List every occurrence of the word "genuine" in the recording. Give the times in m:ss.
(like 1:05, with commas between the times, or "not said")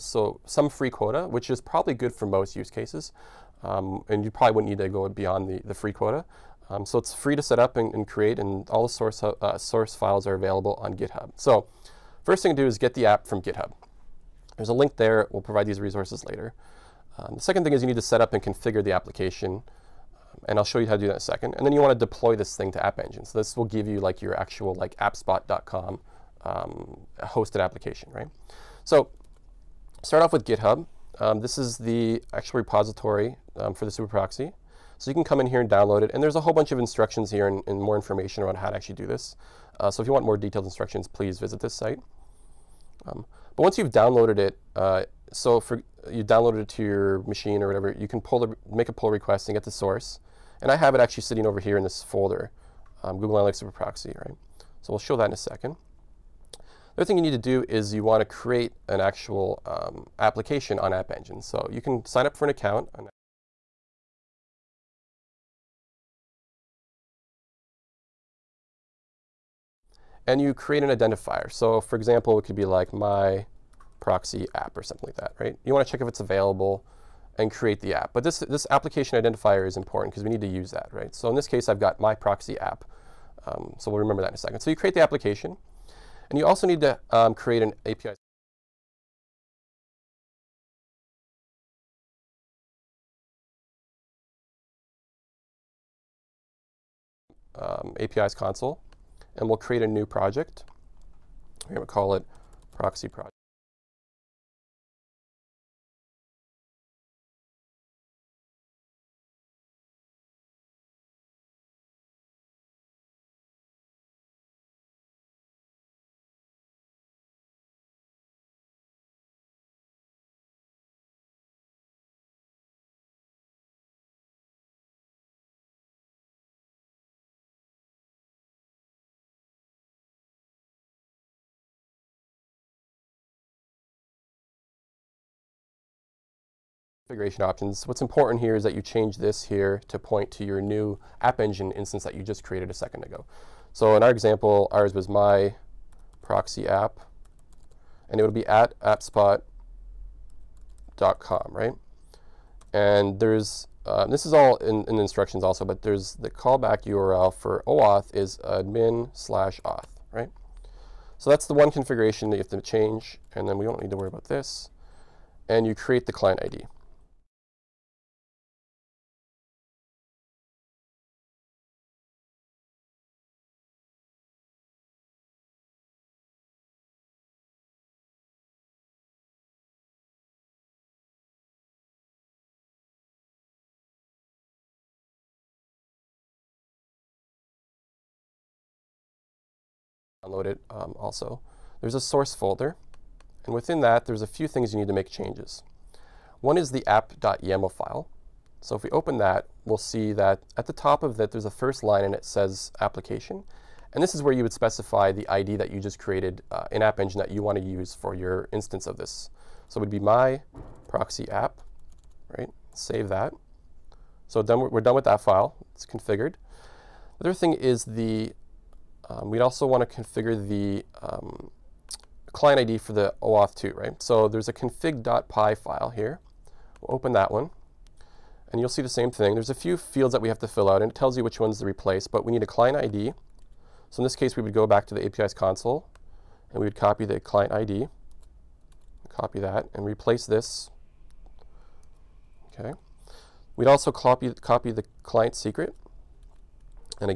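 not said.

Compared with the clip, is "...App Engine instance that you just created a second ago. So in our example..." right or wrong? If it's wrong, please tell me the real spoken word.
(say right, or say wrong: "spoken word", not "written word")
right.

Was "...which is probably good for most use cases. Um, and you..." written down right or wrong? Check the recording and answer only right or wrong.
right.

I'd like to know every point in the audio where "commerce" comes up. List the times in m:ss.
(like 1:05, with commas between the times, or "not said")
not said.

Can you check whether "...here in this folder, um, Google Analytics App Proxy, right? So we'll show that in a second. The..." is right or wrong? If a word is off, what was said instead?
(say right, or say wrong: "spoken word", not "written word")
wrong: "Super", not "App".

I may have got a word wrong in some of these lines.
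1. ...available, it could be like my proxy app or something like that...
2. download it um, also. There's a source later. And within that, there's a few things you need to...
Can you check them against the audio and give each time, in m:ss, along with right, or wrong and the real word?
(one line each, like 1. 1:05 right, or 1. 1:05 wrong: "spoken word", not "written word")
1. 1:11 wrong: "example", not "available"
2. 3:10 wrong: "folder", not "later".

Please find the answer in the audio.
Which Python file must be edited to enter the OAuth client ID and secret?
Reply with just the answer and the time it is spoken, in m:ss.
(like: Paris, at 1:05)
config.py, at 3:44.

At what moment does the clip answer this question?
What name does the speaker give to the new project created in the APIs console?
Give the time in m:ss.
1:42.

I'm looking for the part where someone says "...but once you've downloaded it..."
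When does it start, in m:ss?
0:43.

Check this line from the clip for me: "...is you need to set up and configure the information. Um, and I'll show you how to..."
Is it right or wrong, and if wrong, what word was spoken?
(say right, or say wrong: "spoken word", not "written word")
wrong: "application", not "information".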